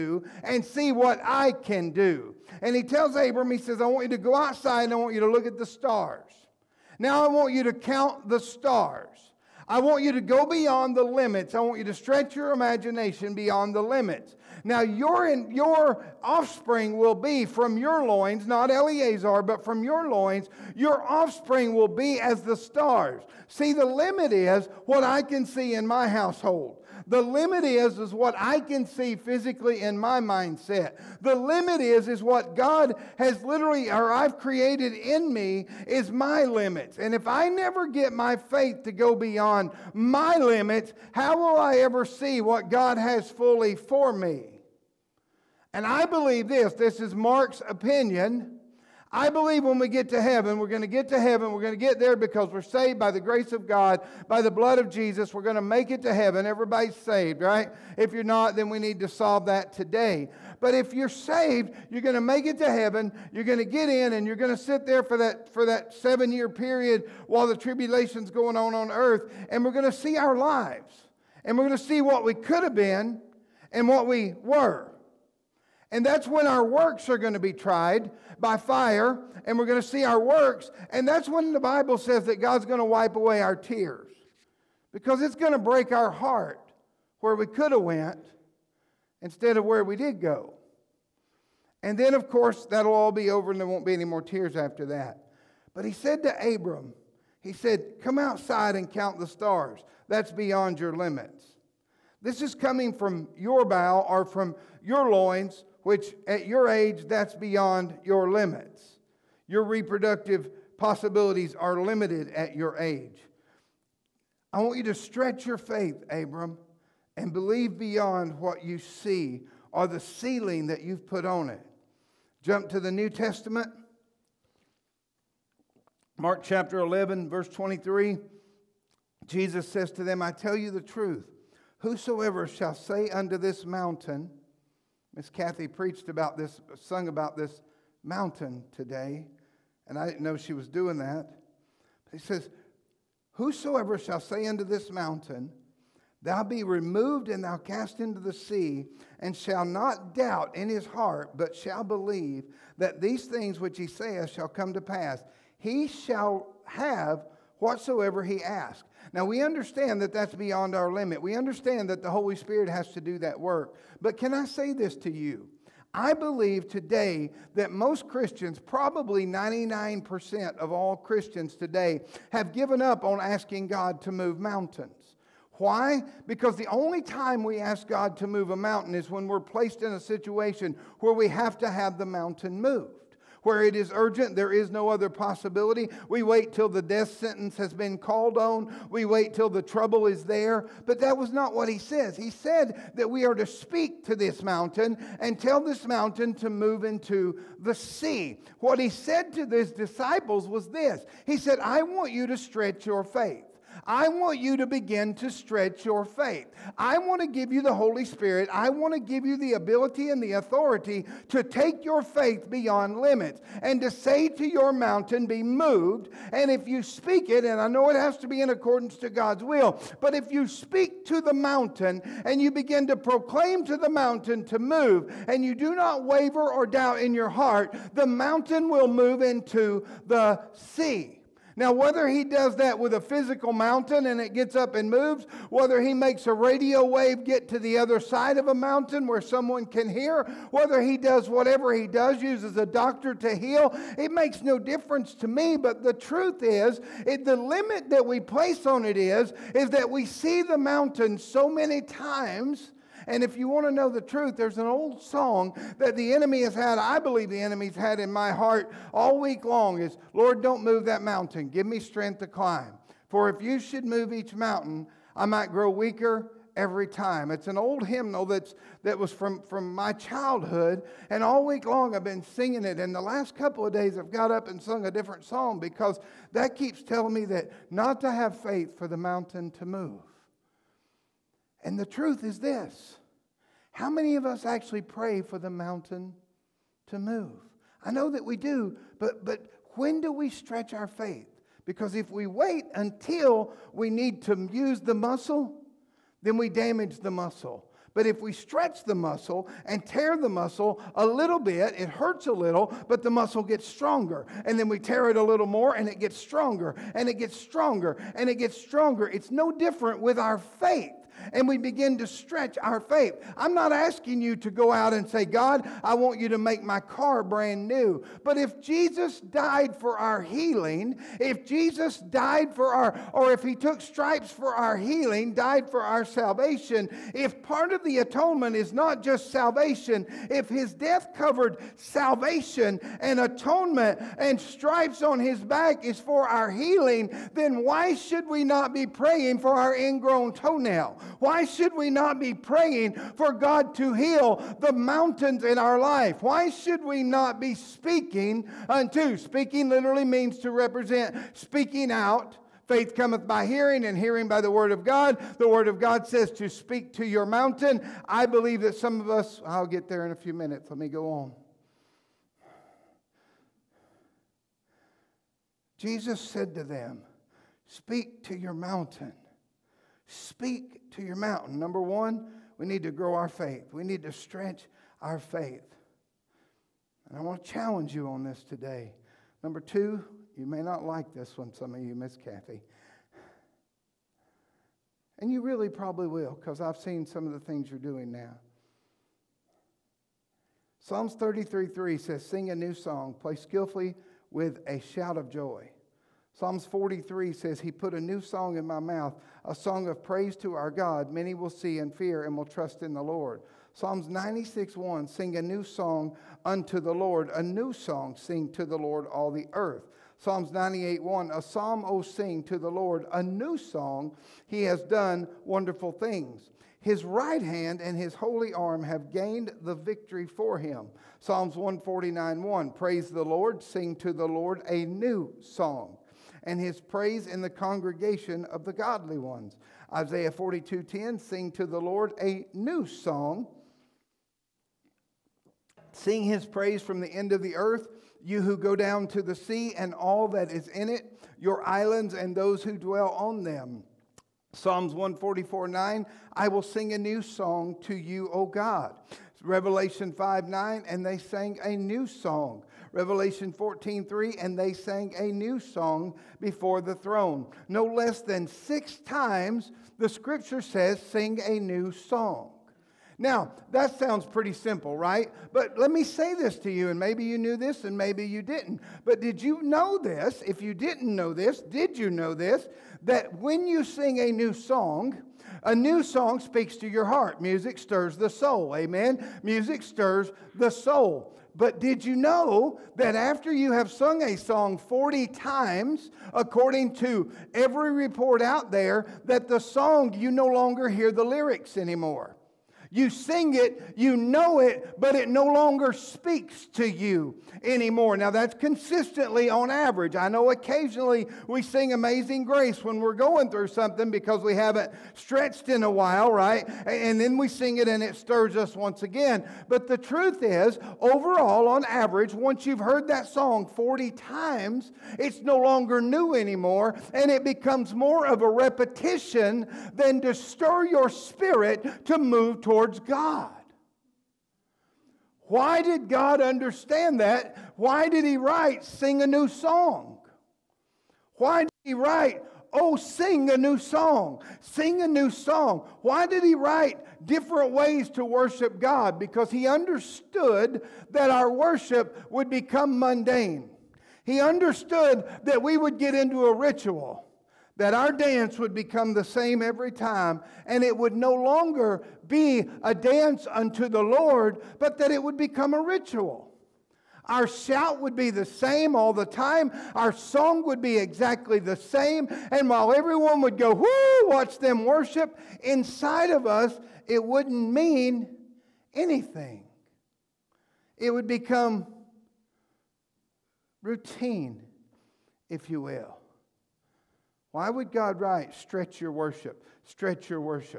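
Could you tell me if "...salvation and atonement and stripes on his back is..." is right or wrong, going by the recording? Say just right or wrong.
right.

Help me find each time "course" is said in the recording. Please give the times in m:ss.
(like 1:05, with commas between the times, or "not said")
1:32.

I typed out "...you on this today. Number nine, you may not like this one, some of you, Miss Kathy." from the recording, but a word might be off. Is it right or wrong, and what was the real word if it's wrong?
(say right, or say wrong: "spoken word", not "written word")
wrong: "two", not "nine".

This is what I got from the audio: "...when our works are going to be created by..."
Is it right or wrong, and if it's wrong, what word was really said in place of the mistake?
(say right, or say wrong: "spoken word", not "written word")
wrong: "tried", not "created".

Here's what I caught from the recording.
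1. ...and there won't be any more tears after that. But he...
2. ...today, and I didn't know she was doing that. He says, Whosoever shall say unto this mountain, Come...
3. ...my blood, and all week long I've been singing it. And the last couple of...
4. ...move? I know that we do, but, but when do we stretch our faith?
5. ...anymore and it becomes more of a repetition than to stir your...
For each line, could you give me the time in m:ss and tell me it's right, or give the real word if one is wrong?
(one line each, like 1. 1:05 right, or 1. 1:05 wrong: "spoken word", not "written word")
1. 1:33 right
2. 2:18 wrong: "Thou", not "Come"
3. 4:29 wrong: "childhood", not "blood"
4. 4:46 right
5. 8:36 right.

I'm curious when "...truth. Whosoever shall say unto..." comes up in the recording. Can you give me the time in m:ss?
2:10.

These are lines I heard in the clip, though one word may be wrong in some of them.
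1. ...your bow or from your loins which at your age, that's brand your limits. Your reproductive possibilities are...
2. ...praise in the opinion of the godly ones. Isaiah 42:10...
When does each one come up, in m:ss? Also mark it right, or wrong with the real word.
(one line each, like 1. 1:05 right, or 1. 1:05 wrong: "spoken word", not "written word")
1. 1:43 wrong: "beyond", not "brand"
2. 7:06 wrong: "congregation", not "opinion".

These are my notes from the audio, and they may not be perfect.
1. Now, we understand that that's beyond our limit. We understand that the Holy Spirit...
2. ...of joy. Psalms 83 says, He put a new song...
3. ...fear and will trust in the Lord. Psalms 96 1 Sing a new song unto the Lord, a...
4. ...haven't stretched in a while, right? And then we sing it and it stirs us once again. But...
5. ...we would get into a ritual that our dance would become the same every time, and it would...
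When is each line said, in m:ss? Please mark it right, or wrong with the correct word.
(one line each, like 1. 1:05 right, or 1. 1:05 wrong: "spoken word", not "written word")
1. 2:39 right
2. 6:35 wrong: "43", not "83"
3. 6:41 right
4. 8:24 right
5. 9:05 right.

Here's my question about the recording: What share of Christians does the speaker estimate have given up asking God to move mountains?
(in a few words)
99%.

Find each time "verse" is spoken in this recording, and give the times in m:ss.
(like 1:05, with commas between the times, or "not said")
2:07.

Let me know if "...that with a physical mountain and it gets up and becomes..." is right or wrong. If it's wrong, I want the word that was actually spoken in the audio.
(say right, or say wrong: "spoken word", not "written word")
wrong: "moves", not "becomes".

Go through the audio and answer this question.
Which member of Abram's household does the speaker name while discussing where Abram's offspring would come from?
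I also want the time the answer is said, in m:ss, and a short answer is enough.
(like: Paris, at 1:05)
Eleazar, at 0:18.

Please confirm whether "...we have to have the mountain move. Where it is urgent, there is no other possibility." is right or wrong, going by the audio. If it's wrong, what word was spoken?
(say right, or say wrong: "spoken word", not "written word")
right.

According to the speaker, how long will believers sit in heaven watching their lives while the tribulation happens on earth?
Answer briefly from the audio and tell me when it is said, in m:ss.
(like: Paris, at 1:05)
7 years, at 1:05.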